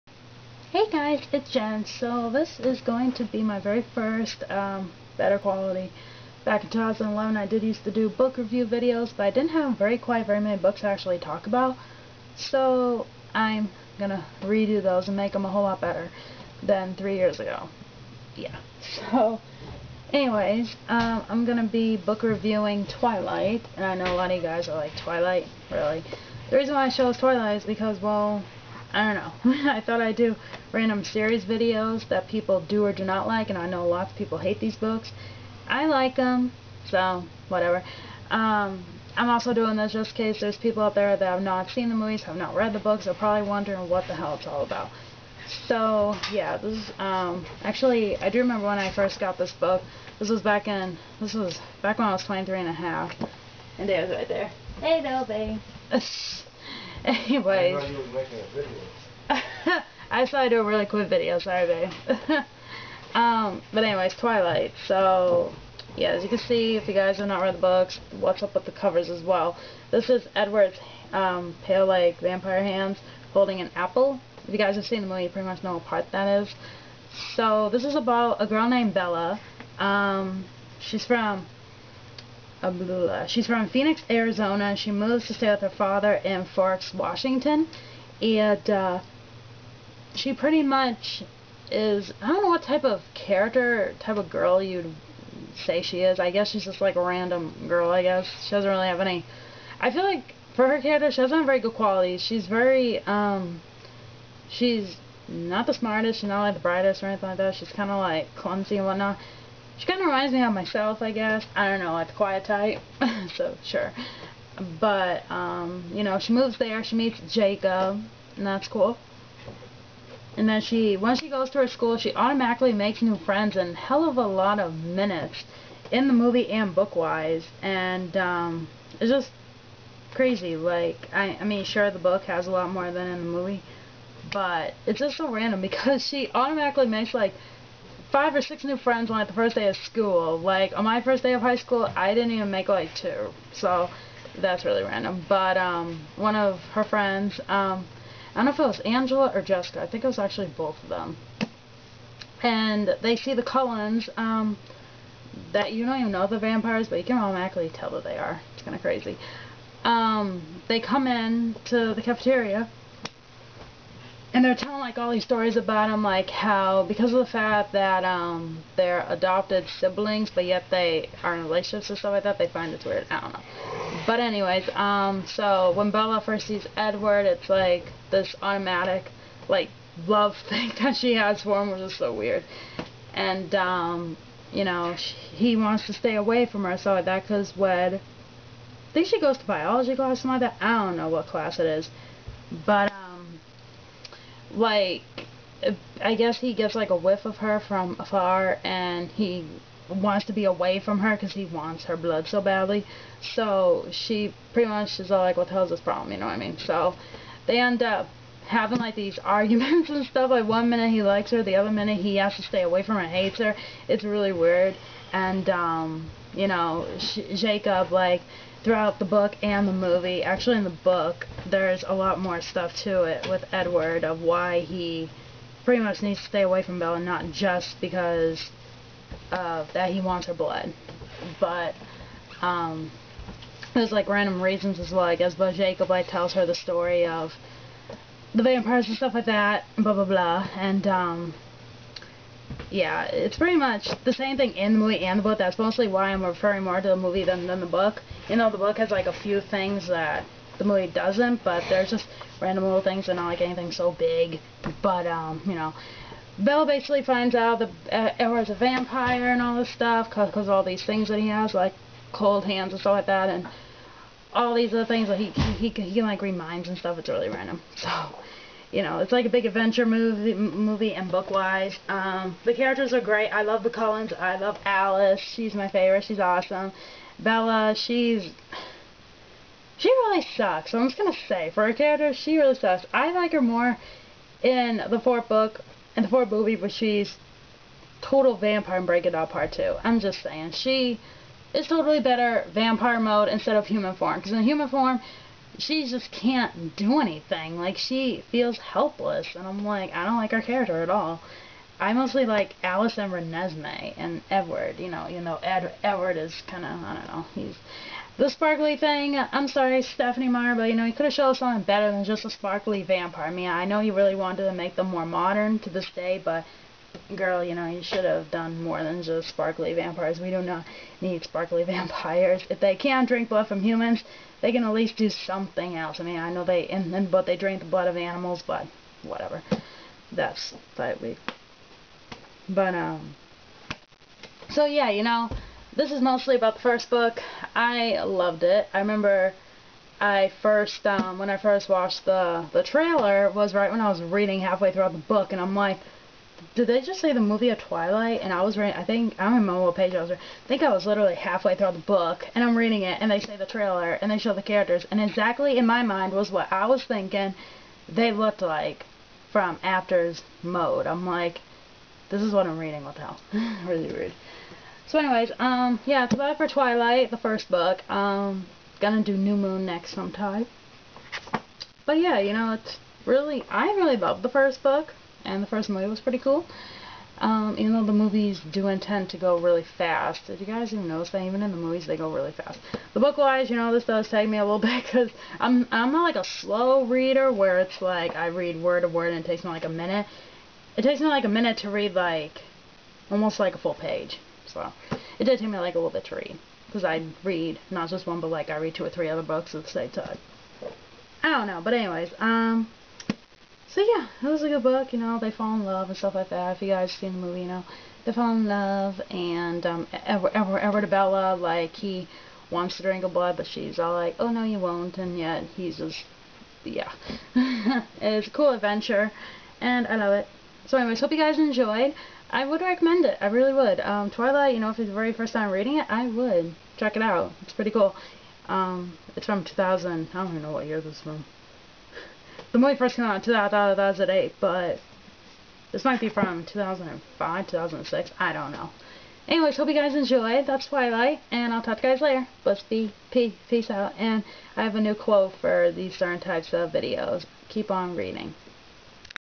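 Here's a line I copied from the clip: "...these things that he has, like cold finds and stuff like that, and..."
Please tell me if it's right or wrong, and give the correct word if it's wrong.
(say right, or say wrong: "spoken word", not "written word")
wrong: "hands", not "finds".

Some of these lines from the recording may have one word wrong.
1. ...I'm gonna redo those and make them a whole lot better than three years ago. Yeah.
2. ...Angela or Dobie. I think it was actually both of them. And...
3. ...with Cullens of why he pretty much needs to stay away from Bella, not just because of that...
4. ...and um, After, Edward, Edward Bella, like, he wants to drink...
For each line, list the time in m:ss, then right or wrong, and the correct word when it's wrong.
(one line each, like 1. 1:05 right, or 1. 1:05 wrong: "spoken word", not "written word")
1. 0:13 right
2. 2:28 wrong: "Jessica", not "Dobie"
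3. 3:43 wrong: "Edward", not "Cullens"
4. 6:49 wrong: "Edward", not "After".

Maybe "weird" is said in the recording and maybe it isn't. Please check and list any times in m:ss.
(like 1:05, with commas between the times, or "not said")
2:52, 3:02, 3:34.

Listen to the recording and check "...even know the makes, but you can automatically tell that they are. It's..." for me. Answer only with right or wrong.
wrong.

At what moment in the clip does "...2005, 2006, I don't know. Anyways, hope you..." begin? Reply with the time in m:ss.
7:16.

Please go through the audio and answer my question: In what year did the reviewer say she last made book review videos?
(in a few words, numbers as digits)
2011.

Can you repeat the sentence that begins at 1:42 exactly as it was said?
She's very, um, she's not the smartest, she's not like the brightest or anything like that.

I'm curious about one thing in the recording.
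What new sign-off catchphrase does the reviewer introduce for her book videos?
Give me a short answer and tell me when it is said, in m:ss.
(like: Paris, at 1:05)
Keep on reading, at 7:27.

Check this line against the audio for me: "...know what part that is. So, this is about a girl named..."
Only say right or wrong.
right.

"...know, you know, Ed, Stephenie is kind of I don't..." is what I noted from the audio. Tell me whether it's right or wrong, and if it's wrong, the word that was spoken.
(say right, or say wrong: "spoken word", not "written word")
wrong: "Edward", not "Stephenie".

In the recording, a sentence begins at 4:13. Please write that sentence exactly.
They're not like anything so big.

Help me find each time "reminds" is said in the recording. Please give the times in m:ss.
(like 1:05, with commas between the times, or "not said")
1:50, 4:26.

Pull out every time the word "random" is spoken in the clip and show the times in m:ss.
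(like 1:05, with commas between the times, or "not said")
0:30, 1:37, 2:15, 2:24, 3:54, 4:12, 4:27.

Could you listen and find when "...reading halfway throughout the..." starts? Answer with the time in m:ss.
5:44.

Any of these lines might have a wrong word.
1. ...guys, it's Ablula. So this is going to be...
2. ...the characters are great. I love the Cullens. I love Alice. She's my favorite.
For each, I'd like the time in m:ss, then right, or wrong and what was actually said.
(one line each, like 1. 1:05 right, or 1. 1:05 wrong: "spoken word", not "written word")
1. 0:00 wrong: "Jen", not "Ablula"
2. 4:32 right.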